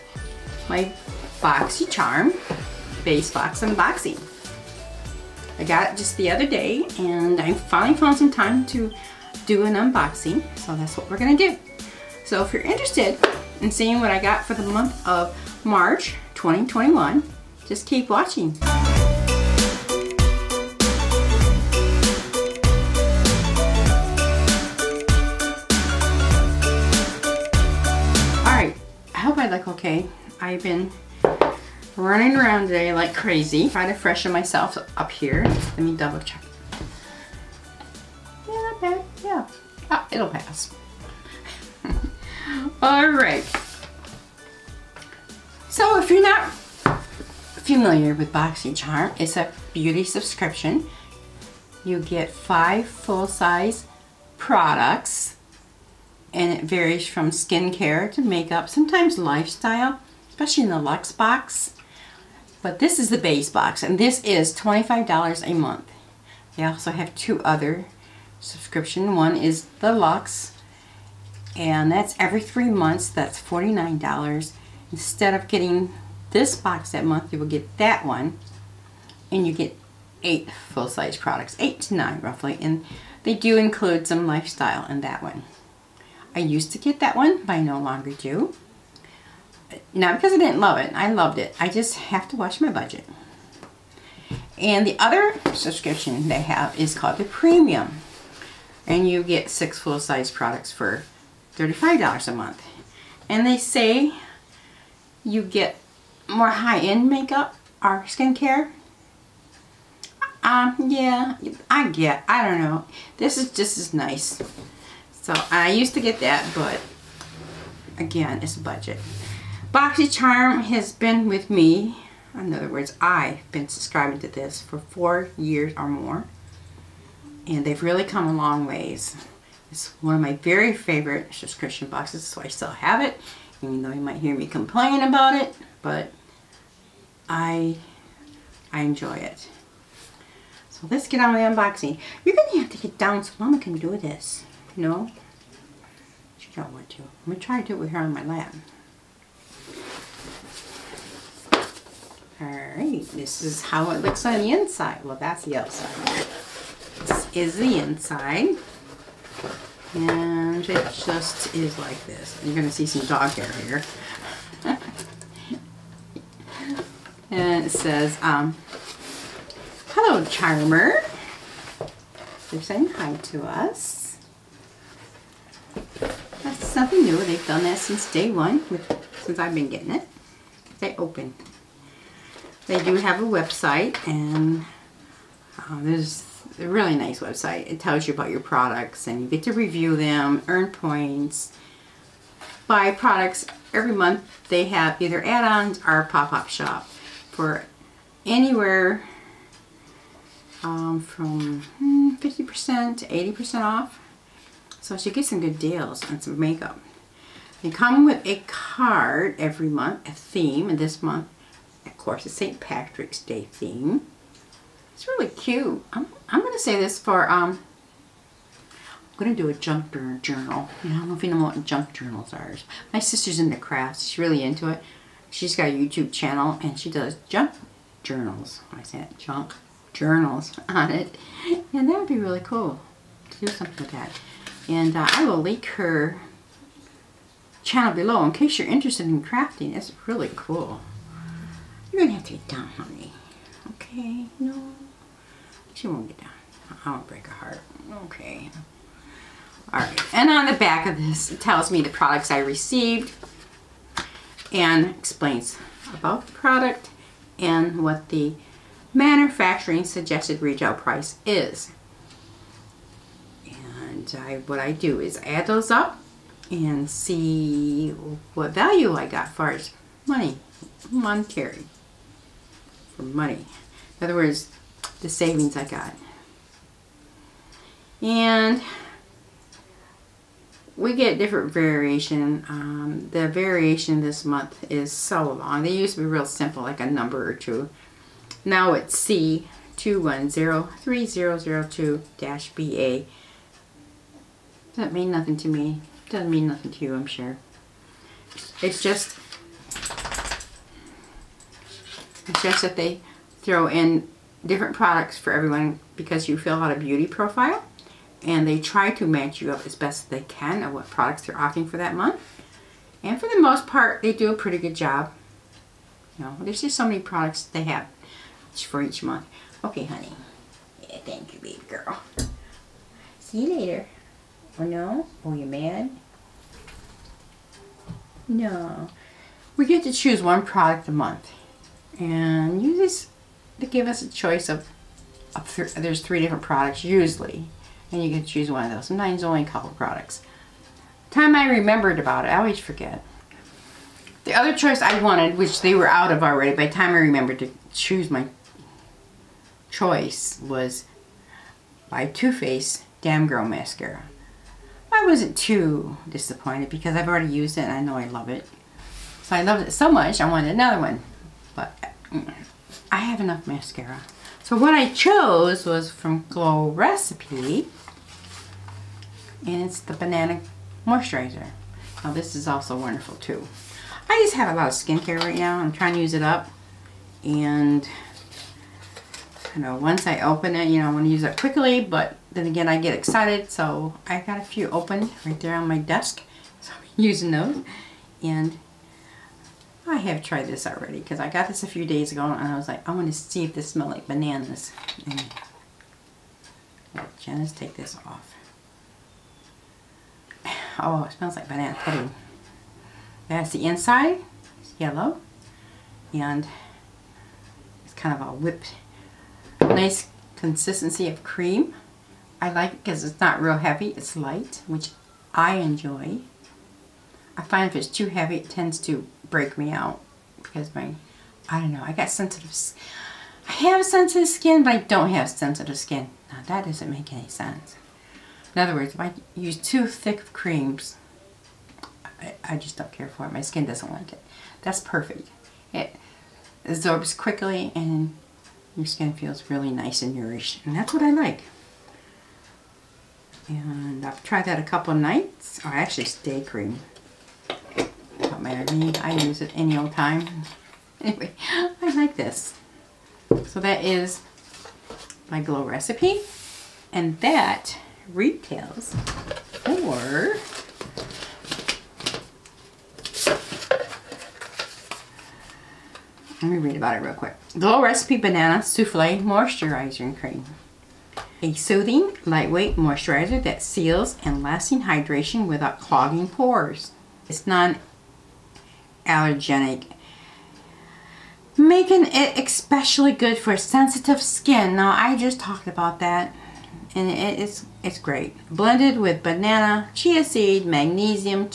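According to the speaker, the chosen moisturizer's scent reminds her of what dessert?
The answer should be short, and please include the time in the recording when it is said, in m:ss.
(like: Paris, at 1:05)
Banana pudding, at 6:41.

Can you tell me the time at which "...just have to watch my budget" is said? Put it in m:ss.
1:31.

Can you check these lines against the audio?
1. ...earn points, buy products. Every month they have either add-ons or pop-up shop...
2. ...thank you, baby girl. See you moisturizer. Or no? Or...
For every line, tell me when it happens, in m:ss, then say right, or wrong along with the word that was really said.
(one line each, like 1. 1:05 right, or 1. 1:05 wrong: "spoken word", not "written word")
1. 3:10 right
2. 5:20 wrong: "later", not "moisturizer".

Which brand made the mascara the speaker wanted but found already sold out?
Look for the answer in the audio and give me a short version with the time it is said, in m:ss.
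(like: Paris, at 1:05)
Too Faced, at 5:52.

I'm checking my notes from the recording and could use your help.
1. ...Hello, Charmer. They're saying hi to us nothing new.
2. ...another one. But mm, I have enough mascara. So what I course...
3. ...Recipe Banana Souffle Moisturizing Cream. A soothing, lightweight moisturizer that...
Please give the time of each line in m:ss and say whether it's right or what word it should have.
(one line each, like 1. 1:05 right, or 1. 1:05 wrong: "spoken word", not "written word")
1. 2:49 right
2. 6:00 wrong: "chose", not "course"
3. 7:47 right.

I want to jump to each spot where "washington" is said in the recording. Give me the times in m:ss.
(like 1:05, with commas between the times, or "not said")
not said.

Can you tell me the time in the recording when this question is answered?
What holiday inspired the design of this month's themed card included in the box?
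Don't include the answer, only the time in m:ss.
3:32.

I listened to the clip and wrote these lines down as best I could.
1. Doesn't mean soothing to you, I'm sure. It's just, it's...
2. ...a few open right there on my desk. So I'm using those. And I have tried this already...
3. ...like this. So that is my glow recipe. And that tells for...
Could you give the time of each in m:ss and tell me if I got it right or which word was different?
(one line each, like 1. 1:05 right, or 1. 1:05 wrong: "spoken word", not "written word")
1. 4:56 wrong: "nothing", not "soothing"
2. 6:24 right
3. 7:31 wrong: "retails", not "tells".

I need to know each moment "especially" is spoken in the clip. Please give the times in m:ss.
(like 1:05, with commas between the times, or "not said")
1:00, 8:02.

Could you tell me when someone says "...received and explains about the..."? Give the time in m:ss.
4:12.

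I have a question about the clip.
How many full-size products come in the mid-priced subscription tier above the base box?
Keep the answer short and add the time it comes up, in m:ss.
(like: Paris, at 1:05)
6, at 1:39.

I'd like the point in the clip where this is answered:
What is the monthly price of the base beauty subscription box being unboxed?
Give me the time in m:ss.
1:04.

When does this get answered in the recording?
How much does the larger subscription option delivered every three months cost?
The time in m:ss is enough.
1:13.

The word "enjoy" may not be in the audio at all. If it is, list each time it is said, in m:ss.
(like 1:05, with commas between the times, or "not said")
2:18, 6:55.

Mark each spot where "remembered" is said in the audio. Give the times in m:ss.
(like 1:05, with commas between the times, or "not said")
5:41, 5:46.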